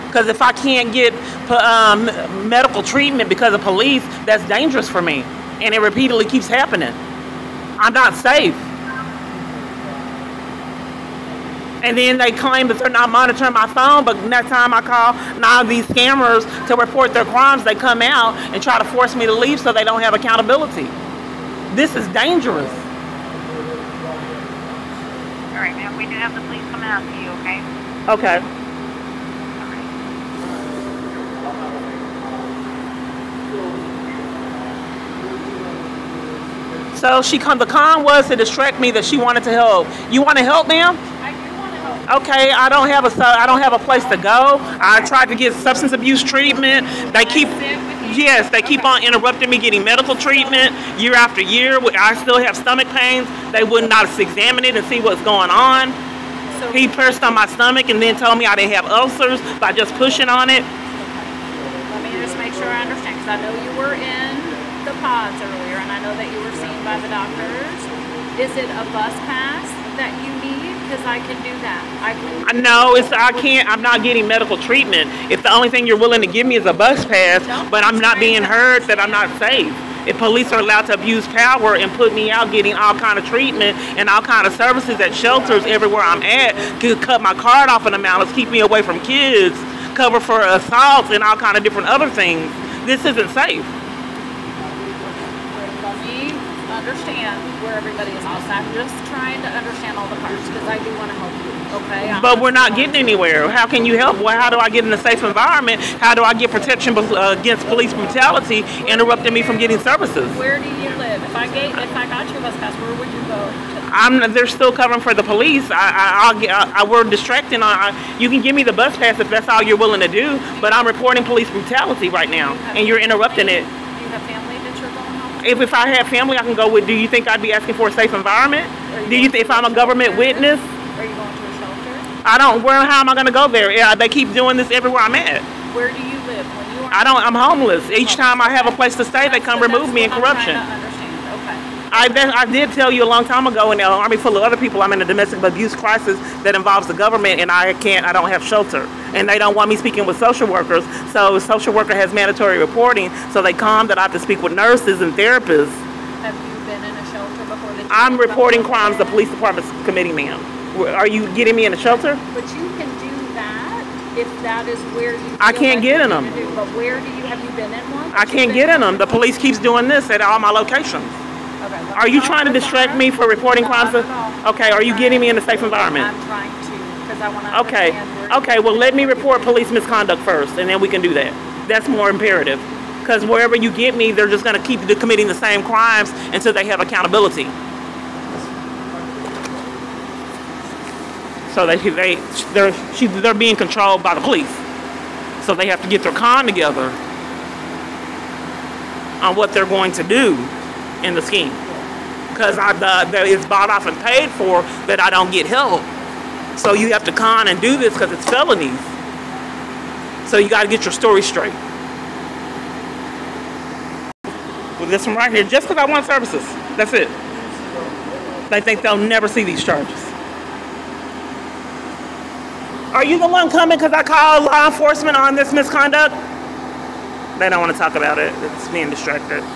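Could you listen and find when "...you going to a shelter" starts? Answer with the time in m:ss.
2:11.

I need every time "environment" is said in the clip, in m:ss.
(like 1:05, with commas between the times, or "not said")
1:45, 2:08, 2:55.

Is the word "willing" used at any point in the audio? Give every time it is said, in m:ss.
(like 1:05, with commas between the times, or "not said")
1:15, 1:59.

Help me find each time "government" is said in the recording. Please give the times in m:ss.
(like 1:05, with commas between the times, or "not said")
2:09, 2:26.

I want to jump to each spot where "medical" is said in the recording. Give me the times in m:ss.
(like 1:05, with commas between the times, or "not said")
0:02, 0:49, 1:14.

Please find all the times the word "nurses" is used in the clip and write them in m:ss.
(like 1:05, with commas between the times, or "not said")
2:34.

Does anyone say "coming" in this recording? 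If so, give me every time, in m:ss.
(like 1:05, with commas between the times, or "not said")
0:26, 3:43.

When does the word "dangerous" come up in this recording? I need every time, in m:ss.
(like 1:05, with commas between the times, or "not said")
0:04, 0:22.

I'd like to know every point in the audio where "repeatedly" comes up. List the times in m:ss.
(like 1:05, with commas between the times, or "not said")
0:05.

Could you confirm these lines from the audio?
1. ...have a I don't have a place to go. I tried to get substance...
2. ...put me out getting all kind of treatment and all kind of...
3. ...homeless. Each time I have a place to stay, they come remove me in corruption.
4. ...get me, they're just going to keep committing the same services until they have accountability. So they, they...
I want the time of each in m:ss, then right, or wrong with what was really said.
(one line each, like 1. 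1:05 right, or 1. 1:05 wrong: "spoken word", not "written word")
1. 0:42 right
2. 1:21 right
3. 2:17 right
4. 3:03 wrong: "crimes", not "services".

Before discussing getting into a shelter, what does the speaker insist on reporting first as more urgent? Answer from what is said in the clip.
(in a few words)
police misconduct.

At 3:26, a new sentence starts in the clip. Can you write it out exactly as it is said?
So you have to con and do this because it's felonies.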